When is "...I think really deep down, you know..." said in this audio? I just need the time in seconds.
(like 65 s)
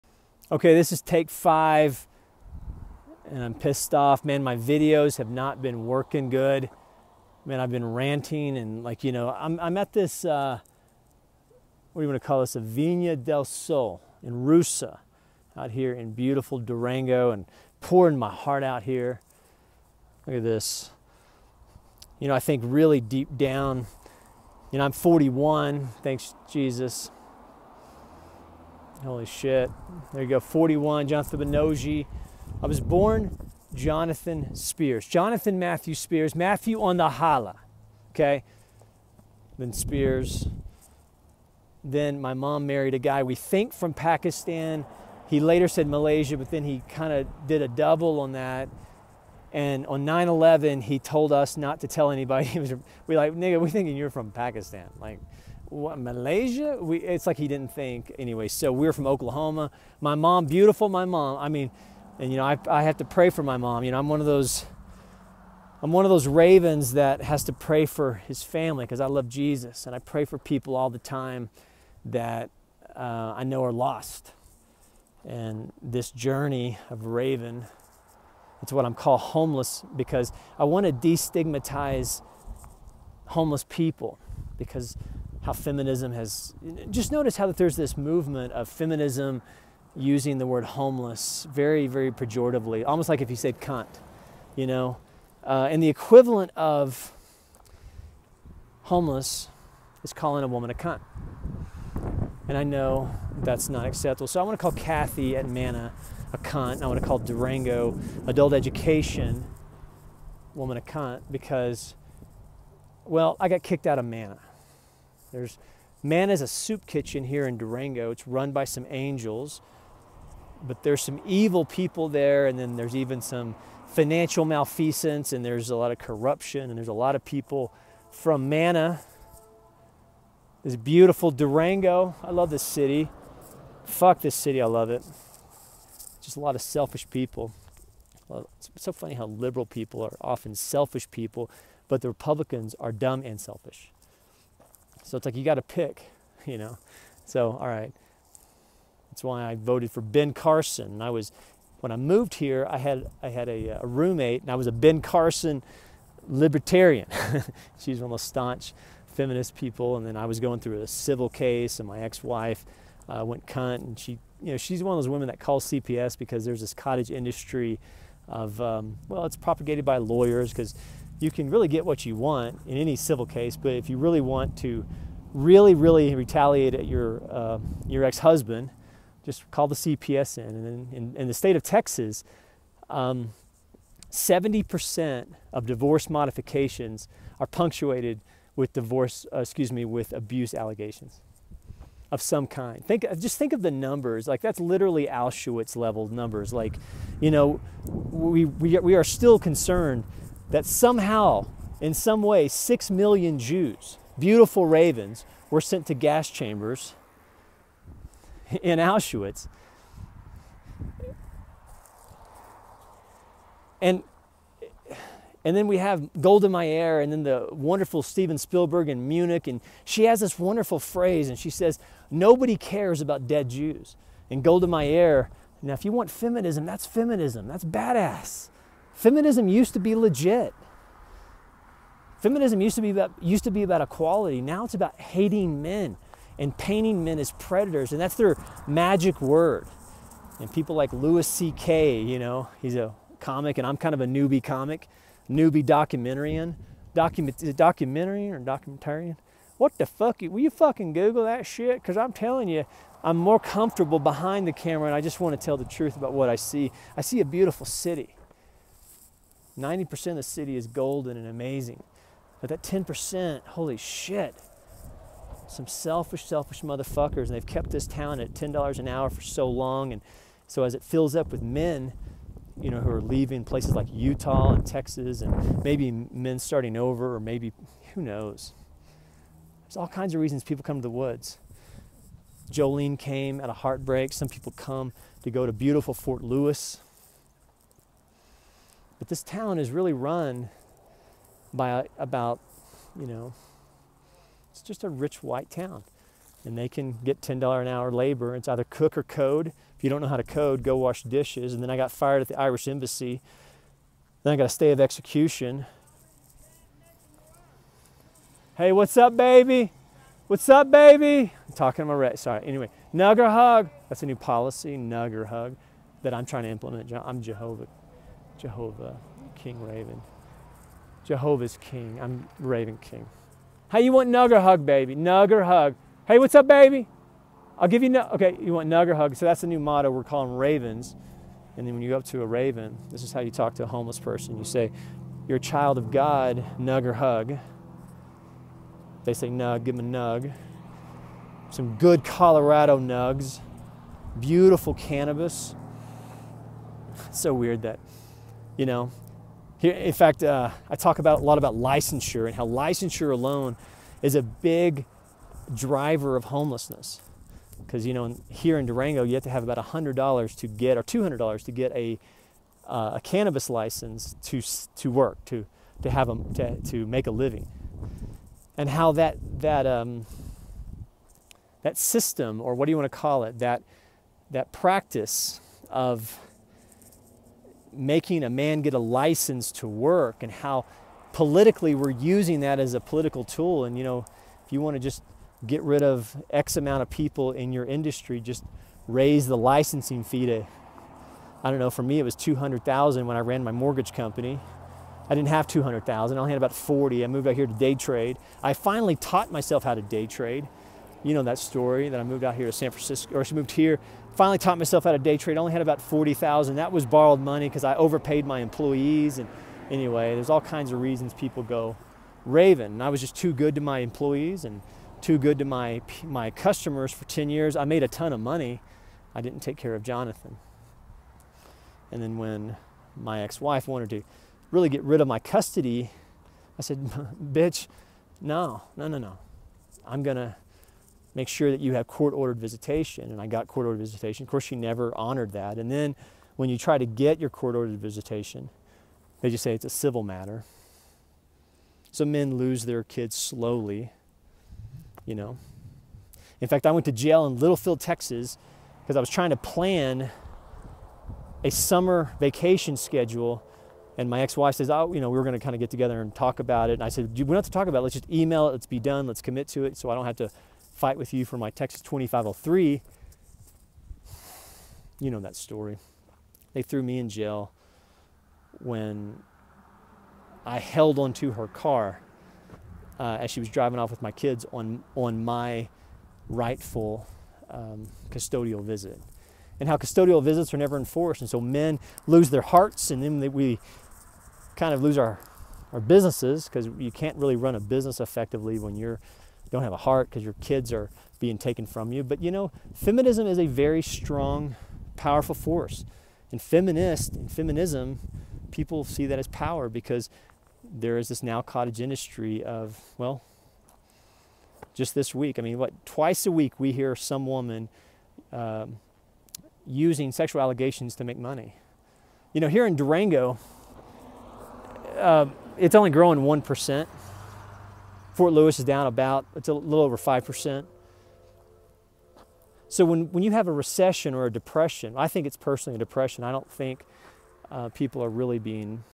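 22 s.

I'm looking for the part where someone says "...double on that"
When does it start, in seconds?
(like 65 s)
47 s.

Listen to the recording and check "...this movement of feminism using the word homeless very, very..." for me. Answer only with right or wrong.
right.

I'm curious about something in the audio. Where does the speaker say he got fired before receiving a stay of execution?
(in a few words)
Irish Embassy.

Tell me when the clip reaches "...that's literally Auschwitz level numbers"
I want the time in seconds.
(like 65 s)
194 s.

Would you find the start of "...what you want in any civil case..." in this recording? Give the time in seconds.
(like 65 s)
171 s.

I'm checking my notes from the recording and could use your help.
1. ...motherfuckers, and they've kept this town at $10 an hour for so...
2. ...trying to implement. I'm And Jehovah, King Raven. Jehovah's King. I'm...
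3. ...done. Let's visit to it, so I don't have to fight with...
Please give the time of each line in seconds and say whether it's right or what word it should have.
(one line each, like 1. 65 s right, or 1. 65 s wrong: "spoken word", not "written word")
1. 266 s right
2. 316 s wrong: "Jehovah", not "And"
3. 458 s wrong: "commit", not "visit".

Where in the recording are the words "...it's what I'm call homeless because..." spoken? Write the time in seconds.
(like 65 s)
78 s.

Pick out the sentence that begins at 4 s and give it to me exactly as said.
Man, my videos have not been working good.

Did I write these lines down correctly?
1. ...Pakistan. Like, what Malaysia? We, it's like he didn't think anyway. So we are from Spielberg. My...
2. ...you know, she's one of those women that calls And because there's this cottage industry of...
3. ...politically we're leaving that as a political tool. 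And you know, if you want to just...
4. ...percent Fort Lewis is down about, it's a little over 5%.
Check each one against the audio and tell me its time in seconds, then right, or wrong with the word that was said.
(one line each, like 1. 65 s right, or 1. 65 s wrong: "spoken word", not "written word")
1. 54 s wrong: "Oklahoma", not "Spielberg"
2. 164 s wrong: "CPS", not "And"
3. 381 s wrong: "using", not "leaving"
4. 516 s right.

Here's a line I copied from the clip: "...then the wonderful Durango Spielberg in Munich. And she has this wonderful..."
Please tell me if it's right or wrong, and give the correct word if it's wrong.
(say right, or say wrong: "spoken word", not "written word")
wrong: "Steven", not "Durango".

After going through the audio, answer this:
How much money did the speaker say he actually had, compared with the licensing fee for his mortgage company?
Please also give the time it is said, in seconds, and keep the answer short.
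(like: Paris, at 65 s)
40,000, at 396 s.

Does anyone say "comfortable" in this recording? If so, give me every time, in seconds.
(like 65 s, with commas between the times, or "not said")
253 s.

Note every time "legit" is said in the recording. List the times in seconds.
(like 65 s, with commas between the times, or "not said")
229 s.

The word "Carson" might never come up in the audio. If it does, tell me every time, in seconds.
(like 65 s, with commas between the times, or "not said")
150 s, 155 s.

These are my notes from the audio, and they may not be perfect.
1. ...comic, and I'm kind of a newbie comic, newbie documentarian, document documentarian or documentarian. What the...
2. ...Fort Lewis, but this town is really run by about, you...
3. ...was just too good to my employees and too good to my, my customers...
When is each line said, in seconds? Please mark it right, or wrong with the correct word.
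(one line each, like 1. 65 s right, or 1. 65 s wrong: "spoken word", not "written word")
1. 243 s right
2. 285 s right
3. 412 s right.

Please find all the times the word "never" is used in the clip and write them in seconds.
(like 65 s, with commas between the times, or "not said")
434 s, 480 s.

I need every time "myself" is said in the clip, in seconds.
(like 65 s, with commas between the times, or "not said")
399 s, 404 s.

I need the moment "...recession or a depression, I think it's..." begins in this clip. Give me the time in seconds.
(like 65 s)
523 s.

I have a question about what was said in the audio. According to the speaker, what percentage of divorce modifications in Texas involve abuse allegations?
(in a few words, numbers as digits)
70%.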